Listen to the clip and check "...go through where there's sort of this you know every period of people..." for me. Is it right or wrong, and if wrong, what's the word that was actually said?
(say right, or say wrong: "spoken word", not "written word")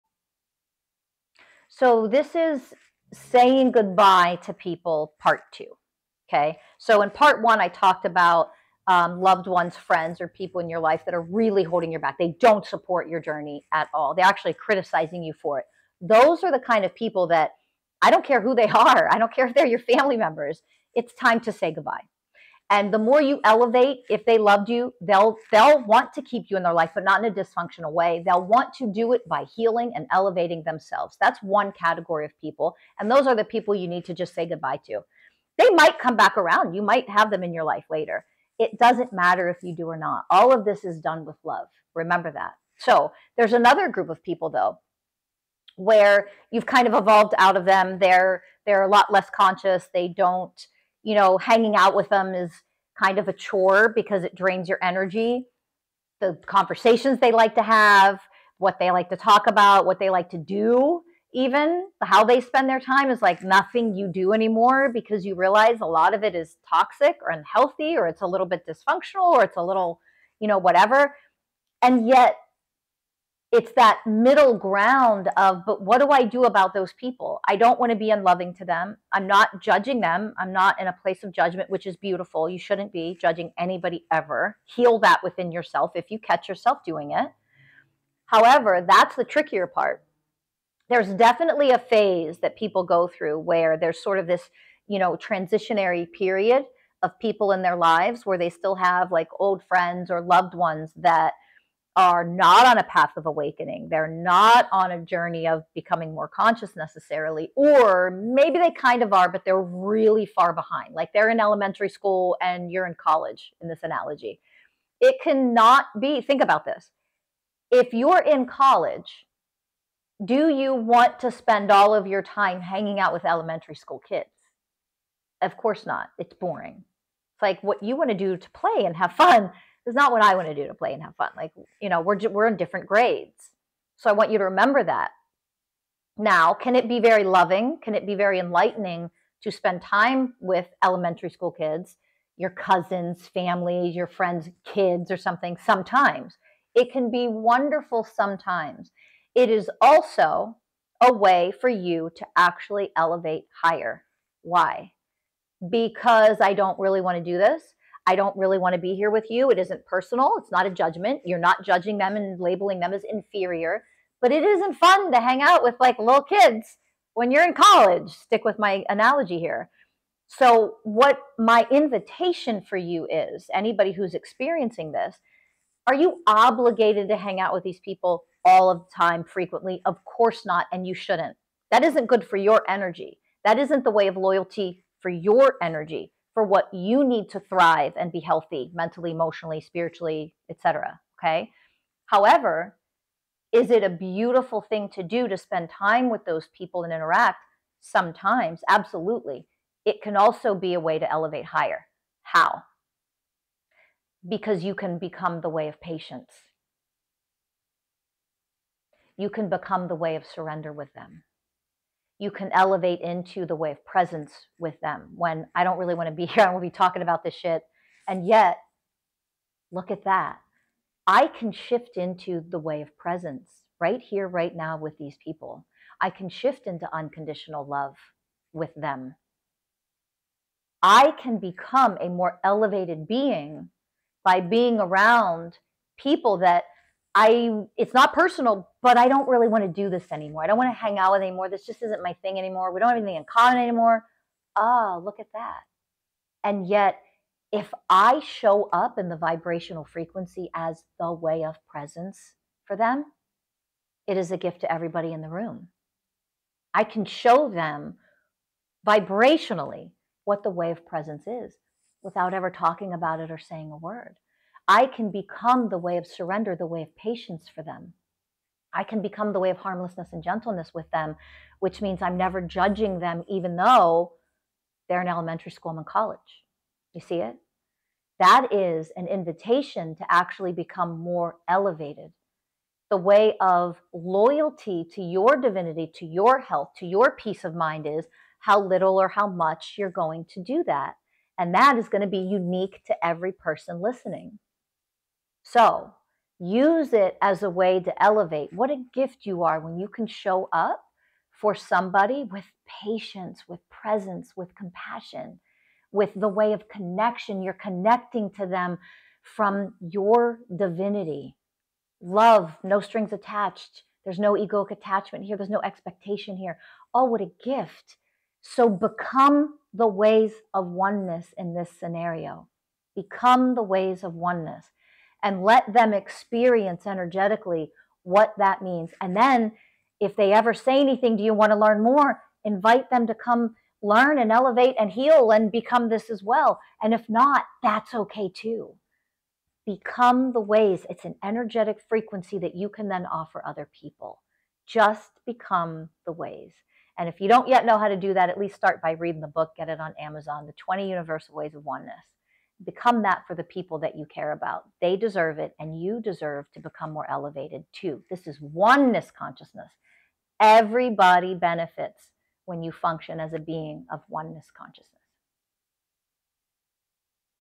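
wrong: "transitionary", not "every".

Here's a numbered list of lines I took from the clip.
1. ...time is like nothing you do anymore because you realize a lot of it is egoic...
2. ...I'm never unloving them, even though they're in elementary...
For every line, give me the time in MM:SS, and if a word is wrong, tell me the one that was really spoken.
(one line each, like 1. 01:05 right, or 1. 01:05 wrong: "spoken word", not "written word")
1. 01:02 wrong: "toxic", not "egoic"
2. 04:32 wrong: "judging", not "unloving".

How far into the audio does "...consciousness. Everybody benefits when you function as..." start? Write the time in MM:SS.
05:59.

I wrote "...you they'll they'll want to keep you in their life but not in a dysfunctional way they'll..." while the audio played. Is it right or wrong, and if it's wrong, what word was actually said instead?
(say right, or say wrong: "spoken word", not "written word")
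right.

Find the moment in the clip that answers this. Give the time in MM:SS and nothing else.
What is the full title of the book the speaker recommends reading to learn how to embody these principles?
05:50.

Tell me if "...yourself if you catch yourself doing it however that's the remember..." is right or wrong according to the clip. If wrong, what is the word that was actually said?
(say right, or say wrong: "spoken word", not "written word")
wrong: "trickier", not "remember".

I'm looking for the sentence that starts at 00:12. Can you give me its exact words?
They don't support your journey at all.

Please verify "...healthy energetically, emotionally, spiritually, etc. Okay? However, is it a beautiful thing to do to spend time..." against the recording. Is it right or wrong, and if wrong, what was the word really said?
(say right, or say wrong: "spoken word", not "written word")
wrong: "mentally", not "energetically".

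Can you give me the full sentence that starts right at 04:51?
And that is going to be unique to every person listening.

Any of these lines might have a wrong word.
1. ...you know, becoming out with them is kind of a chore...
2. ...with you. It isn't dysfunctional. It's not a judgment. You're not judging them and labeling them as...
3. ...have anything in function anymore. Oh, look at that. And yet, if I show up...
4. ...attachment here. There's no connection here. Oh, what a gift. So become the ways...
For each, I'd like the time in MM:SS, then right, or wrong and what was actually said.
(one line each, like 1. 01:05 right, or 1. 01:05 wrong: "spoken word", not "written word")
1. 00:51 wrong: "hanging", not "becoming"
2. 02:39 wrong: "personal", not "dysfunctional"
3. 04:02 wrong: "common", not "function"
4. 05:14 wrong: "expectation", not "connection".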